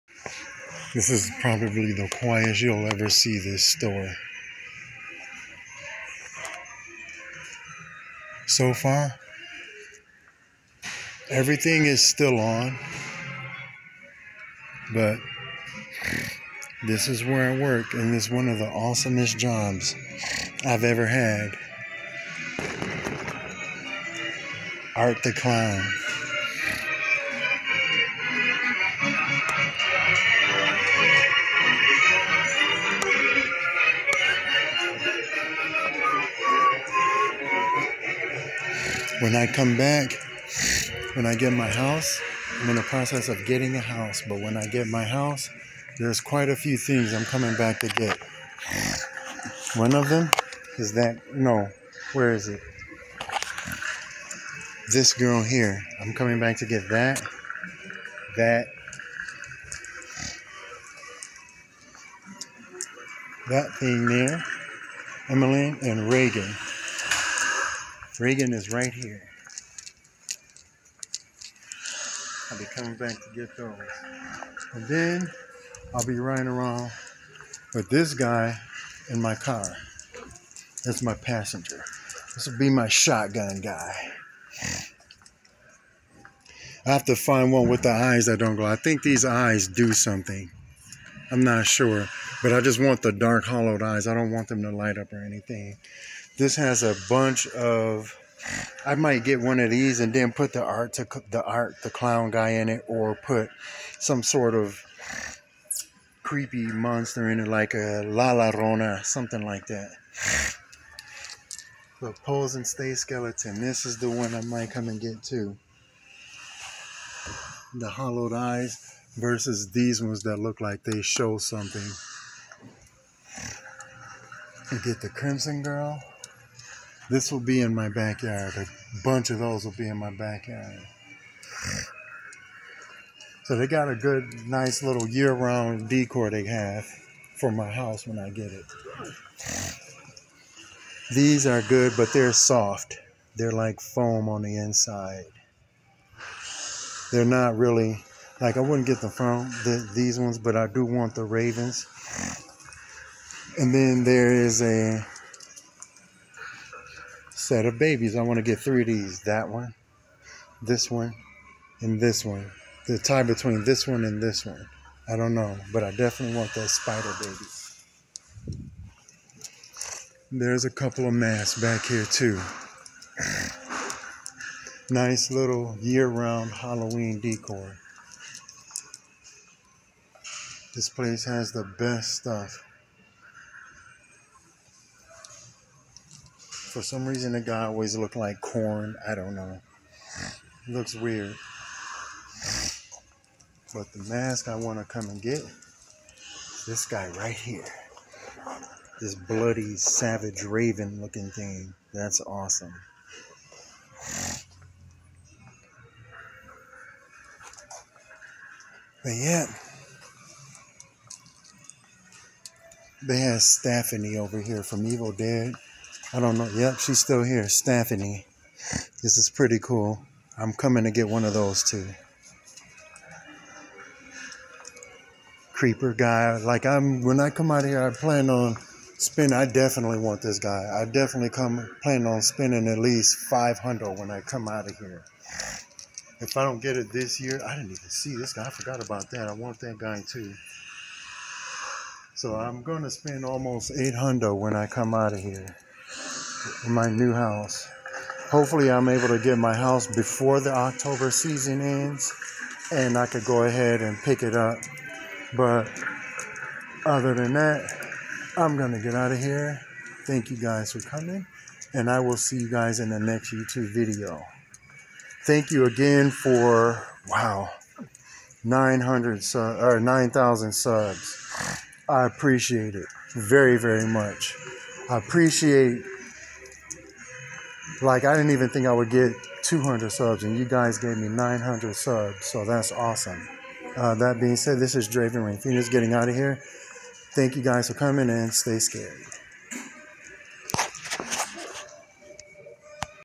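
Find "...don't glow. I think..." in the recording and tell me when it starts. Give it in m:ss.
1:28.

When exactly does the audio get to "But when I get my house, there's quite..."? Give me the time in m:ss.
0:44.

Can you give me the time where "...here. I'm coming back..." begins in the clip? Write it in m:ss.
0:55.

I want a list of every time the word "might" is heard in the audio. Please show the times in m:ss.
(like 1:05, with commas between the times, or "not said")
1:38, 1:54.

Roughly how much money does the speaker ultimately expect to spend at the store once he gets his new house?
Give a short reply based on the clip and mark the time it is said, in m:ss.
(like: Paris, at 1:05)
almost 800, at 4:03.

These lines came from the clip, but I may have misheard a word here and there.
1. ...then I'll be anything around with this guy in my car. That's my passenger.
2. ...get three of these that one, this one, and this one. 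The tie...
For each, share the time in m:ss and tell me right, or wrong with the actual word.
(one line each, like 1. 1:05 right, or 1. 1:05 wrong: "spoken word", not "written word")
1. 1:14 wrong: "riding", not "anything"
2. 2:38 right.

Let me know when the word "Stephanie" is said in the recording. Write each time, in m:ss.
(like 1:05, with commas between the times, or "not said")
3:33, 3:37.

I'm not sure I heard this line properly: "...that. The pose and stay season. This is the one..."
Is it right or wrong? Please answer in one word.
wrong.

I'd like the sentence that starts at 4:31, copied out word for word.
I appreciate it very, very much.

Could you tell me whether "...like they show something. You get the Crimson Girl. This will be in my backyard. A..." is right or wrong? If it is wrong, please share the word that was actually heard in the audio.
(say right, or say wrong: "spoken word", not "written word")
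right.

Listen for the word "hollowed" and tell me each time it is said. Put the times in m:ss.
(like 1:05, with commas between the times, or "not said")
1:33, 1:57.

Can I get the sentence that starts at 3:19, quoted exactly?
This bloody, savage, raven looking thing.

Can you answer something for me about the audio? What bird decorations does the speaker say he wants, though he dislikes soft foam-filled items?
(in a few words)
Ravens.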